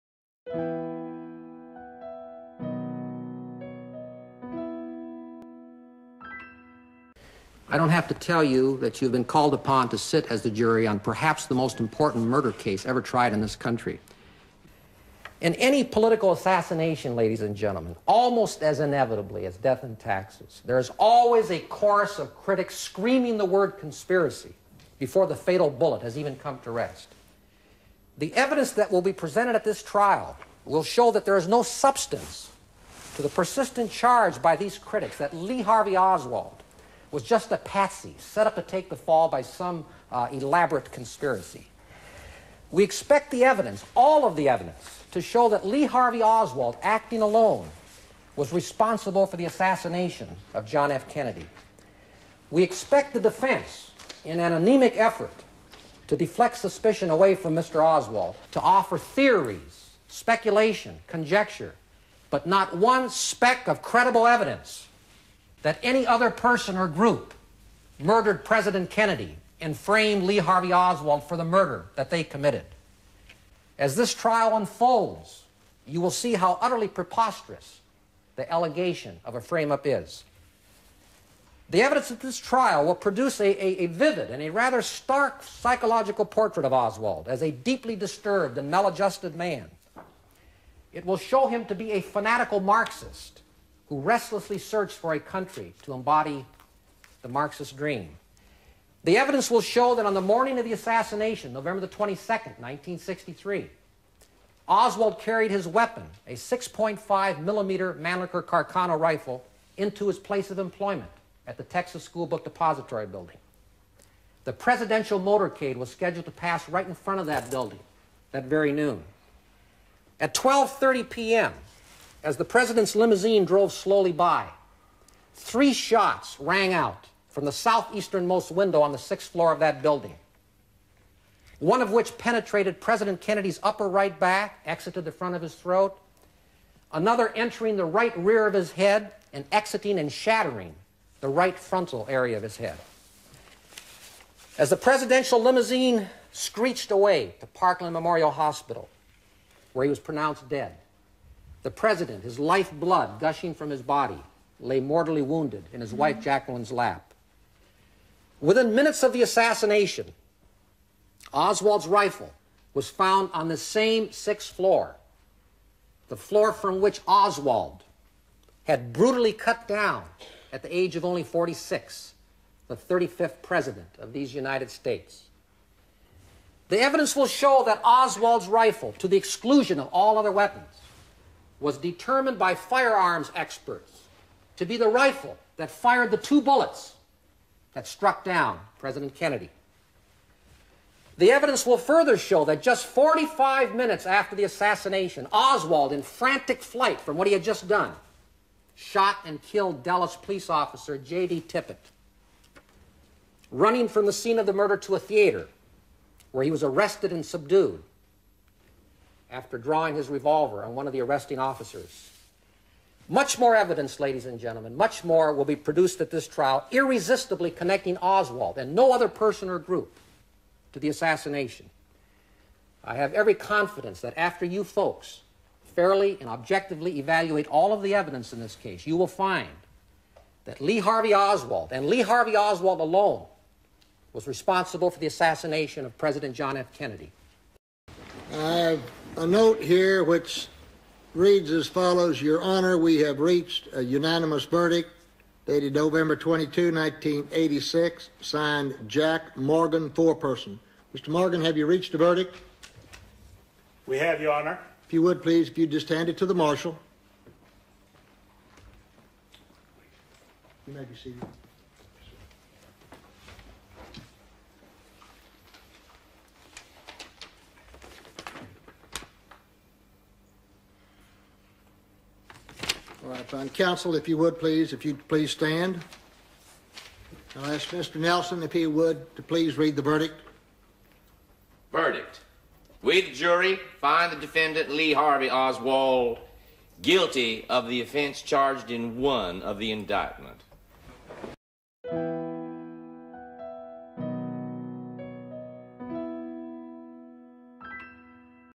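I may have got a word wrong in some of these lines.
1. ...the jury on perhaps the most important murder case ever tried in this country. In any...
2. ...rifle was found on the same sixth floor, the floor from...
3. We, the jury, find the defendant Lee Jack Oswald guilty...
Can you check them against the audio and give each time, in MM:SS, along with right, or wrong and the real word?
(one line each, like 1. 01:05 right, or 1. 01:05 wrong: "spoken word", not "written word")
1. 00:10 right
2. 02:41 right
3. 04:42 wrong: "Harvey", not "Jack".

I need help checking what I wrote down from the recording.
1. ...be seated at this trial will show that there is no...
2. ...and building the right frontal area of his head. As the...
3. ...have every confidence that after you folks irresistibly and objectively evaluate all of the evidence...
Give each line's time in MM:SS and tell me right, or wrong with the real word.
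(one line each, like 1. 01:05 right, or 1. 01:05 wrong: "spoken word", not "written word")
1. 00:29 wrong: "presented", not "seated"
2. 02:19 wrong: "shattering", not "building"
3. 03:42 wrong: "fairly", not "irresistibly".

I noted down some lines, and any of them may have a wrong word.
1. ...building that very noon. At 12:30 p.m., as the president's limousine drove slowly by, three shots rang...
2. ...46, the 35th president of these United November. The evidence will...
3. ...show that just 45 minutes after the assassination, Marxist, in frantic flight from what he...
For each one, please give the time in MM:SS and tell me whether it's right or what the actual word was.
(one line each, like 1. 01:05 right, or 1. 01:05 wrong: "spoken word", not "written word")
1. 01:57 right
2. 02:51 wrong: "States", not "November"
3. 03:12 wrong: "Oswald", not "Marxist".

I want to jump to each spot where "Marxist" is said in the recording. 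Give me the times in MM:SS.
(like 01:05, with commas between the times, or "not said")
01:32, 01:37.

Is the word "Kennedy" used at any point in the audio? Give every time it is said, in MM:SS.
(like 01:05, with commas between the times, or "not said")
00:51, 01:08, 02:13, 03:09, 03:56.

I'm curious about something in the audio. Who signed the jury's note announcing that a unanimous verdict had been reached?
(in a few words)
Jack Morgan.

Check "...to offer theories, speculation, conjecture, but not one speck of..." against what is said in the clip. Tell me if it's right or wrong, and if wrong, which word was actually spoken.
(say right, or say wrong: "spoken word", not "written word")
right.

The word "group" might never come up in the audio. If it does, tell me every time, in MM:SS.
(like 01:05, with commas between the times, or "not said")
01:06, 03:39.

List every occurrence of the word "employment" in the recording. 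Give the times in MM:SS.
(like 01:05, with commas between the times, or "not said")
01:50.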